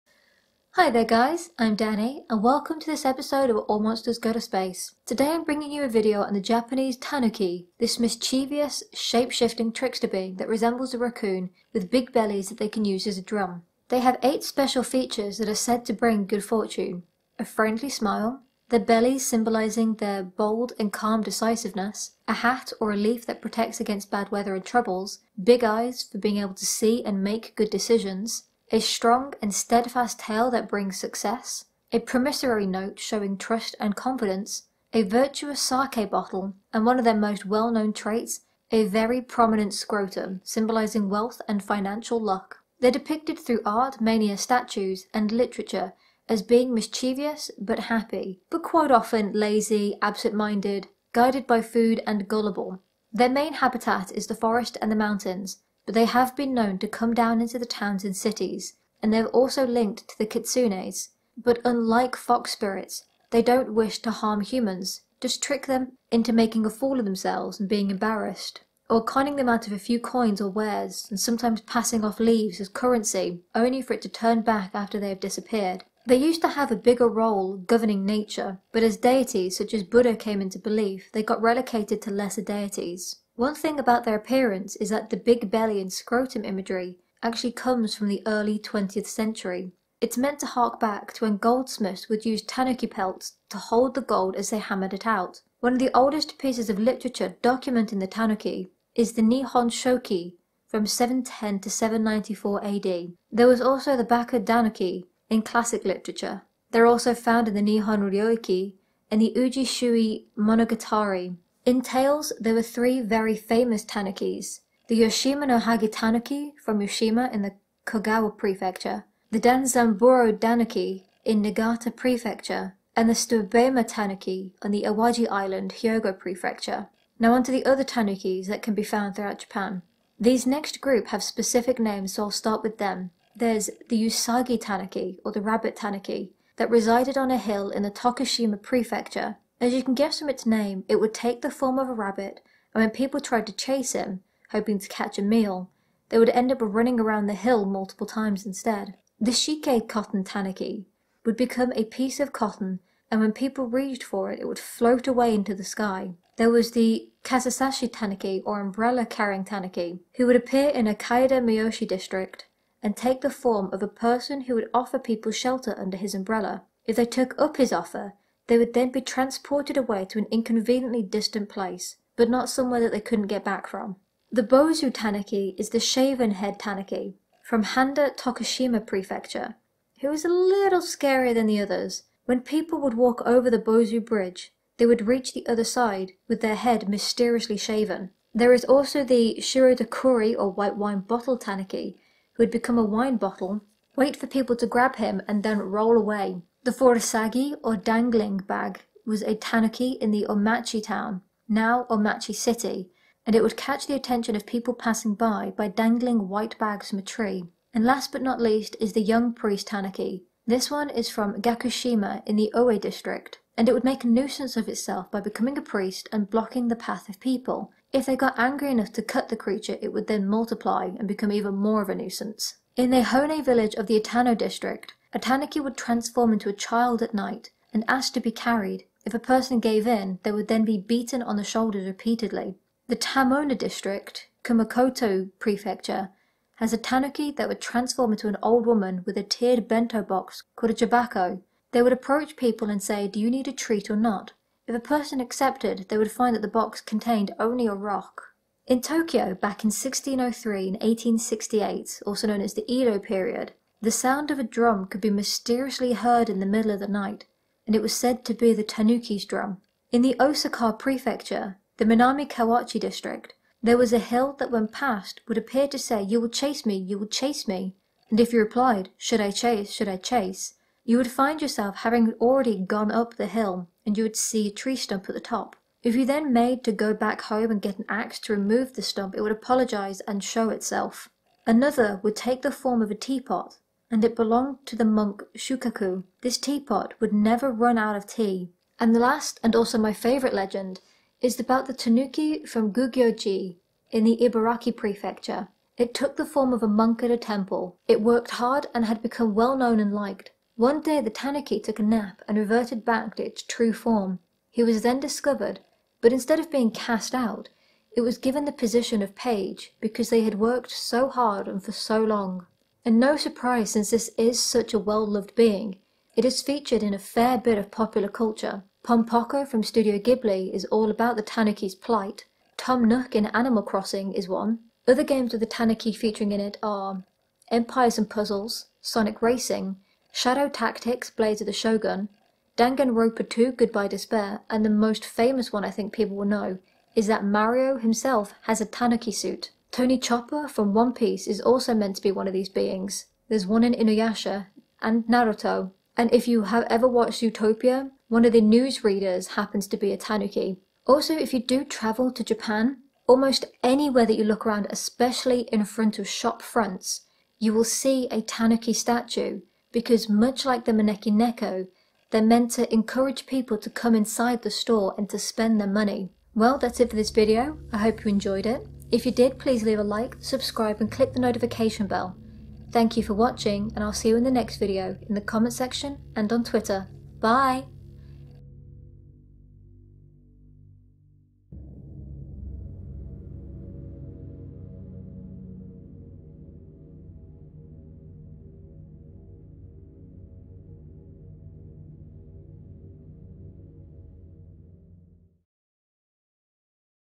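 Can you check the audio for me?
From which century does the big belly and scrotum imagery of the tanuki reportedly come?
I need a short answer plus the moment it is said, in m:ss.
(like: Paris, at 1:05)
early 20th century, at 1:28.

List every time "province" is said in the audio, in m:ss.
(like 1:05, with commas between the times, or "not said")
not said.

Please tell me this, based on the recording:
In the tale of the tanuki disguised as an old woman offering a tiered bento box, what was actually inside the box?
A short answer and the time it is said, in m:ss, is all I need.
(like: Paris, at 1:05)
a rock, at 4:07.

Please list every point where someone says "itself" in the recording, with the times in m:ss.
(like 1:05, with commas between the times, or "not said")
3:34, 4:40.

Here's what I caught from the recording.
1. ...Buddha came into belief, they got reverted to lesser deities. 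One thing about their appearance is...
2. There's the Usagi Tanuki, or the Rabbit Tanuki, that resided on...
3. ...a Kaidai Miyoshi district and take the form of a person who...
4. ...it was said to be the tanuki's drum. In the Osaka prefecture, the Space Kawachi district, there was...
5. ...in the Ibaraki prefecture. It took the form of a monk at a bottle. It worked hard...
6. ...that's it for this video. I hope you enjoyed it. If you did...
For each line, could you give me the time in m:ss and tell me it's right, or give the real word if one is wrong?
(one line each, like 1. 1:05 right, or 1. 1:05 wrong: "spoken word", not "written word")
1. 1:19 wrong: "relocated", not "reverted"
2. 2:13 right
3. 2:40 right
4. 4:17 wrong: "Minami", not "Space"
5. 4:53 wrong: "temple", not "bottle"
6. 6:06 right.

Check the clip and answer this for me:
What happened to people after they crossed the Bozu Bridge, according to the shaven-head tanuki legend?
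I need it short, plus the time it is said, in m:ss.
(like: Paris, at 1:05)
Head mysteriously shaven, at 3:06.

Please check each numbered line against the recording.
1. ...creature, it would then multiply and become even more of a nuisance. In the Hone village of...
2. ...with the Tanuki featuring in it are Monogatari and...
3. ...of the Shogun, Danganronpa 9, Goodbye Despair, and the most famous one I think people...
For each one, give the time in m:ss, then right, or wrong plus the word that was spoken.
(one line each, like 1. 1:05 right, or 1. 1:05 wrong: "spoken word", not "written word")
1. 3:39 right
2. 5:25 wrong: "Empires", not "Monogatari"
3. 5:31 wrong: "2", not "9".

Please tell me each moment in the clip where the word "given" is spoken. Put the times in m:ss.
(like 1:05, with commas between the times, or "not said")
5:08.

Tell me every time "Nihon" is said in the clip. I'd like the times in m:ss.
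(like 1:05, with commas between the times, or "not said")
1:39, 1:47.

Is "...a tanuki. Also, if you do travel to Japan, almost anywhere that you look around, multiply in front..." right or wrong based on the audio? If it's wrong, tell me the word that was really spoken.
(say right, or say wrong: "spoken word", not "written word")
wrong: "especially", not "multiply".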